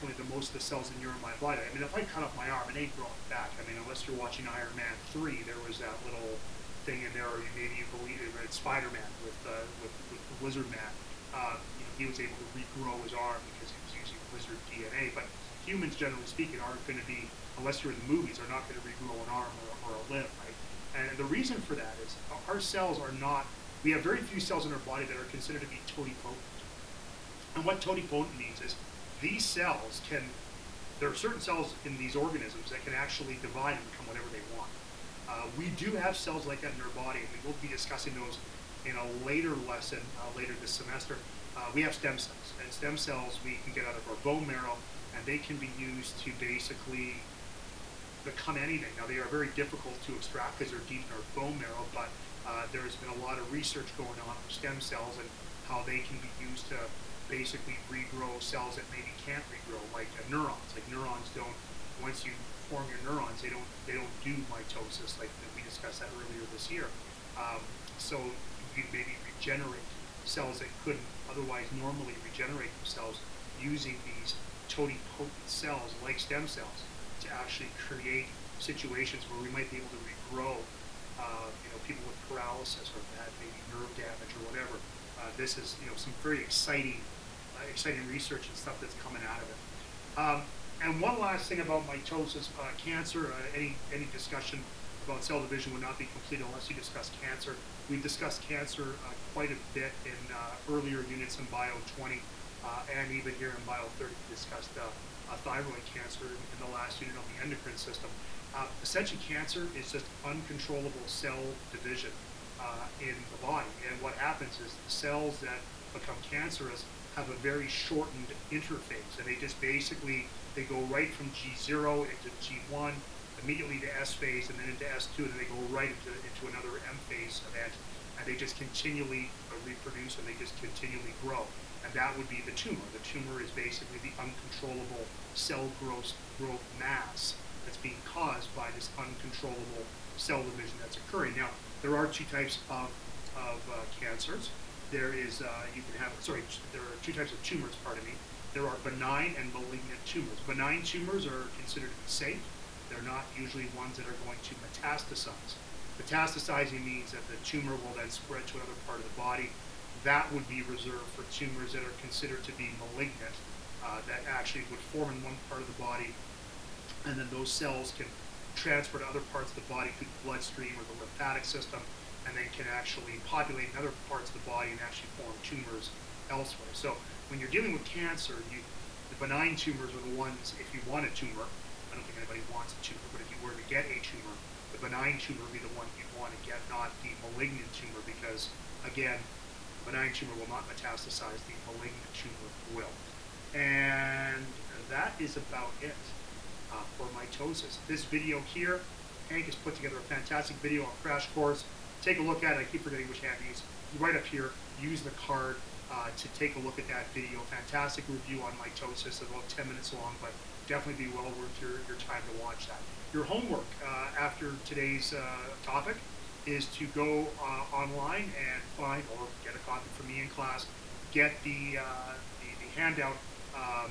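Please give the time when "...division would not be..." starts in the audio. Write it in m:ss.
1:35.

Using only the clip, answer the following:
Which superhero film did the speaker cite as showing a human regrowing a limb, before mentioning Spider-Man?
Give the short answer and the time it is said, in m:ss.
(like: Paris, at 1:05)
Iron Man 3, at 0:04.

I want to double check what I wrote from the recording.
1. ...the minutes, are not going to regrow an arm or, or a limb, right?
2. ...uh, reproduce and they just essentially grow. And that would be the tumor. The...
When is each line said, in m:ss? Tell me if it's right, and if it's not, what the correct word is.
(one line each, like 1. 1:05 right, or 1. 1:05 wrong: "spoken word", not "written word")
1. 0:17 wrong: "movies", not "minutes"
2. 2:09 wrong: "continually", not "essentially".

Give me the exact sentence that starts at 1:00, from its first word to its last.
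Like neurons don't once you form your neurons, they don't they don't do mitosis like we discussed that earlier this year.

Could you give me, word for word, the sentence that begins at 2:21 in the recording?
Now, there are two types of, of uh, cancers.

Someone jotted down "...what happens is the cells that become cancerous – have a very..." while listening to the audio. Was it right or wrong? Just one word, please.
right.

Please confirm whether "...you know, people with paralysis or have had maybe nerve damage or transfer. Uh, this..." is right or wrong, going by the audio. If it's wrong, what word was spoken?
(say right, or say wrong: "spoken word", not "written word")
wrong: "whatever", not "transfer".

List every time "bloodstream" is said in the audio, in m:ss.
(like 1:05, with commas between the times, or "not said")
2:50.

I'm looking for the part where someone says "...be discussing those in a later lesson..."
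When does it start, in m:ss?
0:37.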